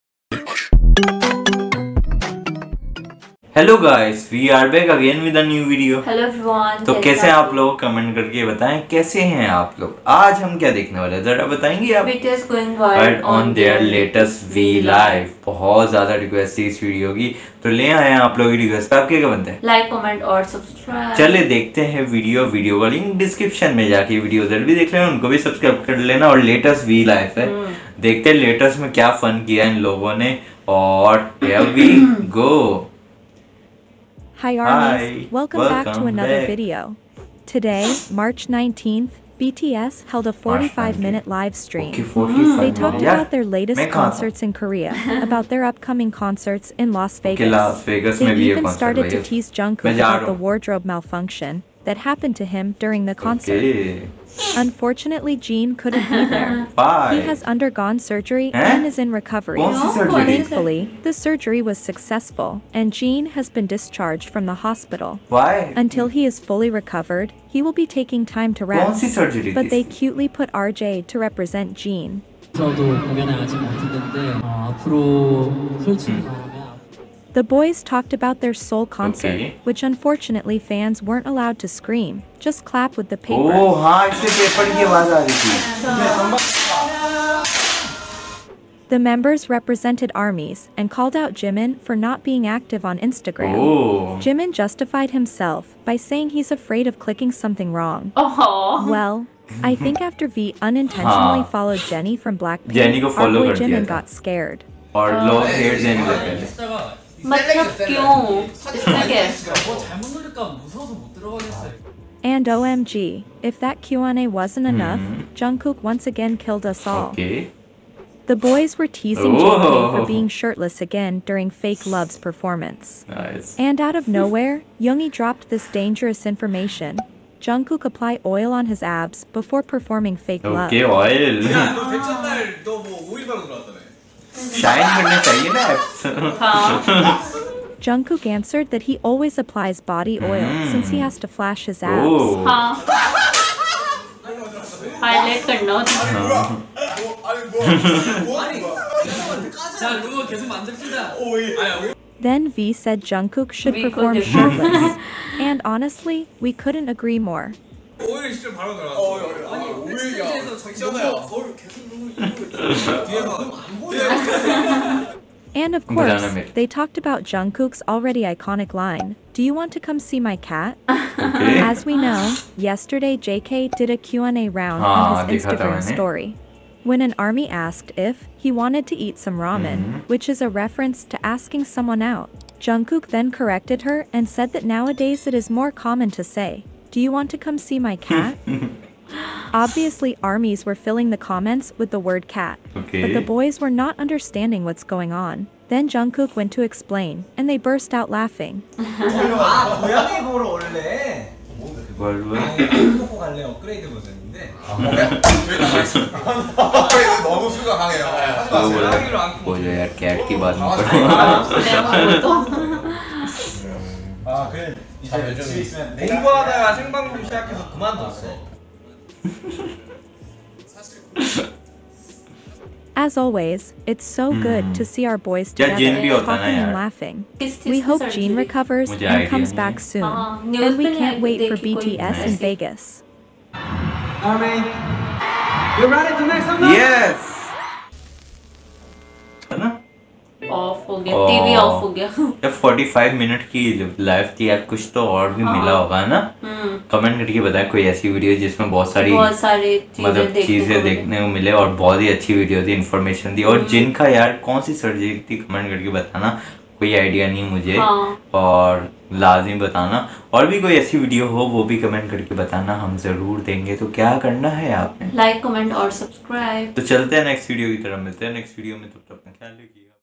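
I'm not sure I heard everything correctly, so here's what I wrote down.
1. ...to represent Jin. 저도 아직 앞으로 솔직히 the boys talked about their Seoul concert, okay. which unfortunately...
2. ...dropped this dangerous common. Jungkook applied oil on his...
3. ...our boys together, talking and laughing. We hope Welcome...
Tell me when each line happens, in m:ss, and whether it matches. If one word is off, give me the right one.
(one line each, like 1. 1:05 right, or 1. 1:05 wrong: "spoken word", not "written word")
1. 1:11 right
2. 2:05 wrong: "information", not "common"
3. 3:45 wrong: "Jin", not "Welcome".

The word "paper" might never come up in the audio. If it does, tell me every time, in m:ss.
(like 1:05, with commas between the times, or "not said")
1:23.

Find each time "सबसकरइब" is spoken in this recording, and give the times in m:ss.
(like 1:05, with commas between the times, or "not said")
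0:20, 0:25, 4:25.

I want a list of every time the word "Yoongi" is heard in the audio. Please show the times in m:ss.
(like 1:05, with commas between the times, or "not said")
2:04.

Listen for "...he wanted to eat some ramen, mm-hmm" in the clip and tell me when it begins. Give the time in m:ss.
2:58.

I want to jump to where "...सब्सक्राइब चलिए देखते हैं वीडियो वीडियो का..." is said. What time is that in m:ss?
0:20.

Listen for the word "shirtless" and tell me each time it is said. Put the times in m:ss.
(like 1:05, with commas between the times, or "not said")
2:00, 2:34.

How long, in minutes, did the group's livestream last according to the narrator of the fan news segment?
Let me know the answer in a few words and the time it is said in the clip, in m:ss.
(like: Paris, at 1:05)
45, at 0:40.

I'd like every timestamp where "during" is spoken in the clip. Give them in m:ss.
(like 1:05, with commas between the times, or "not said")
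0:52, 2:01.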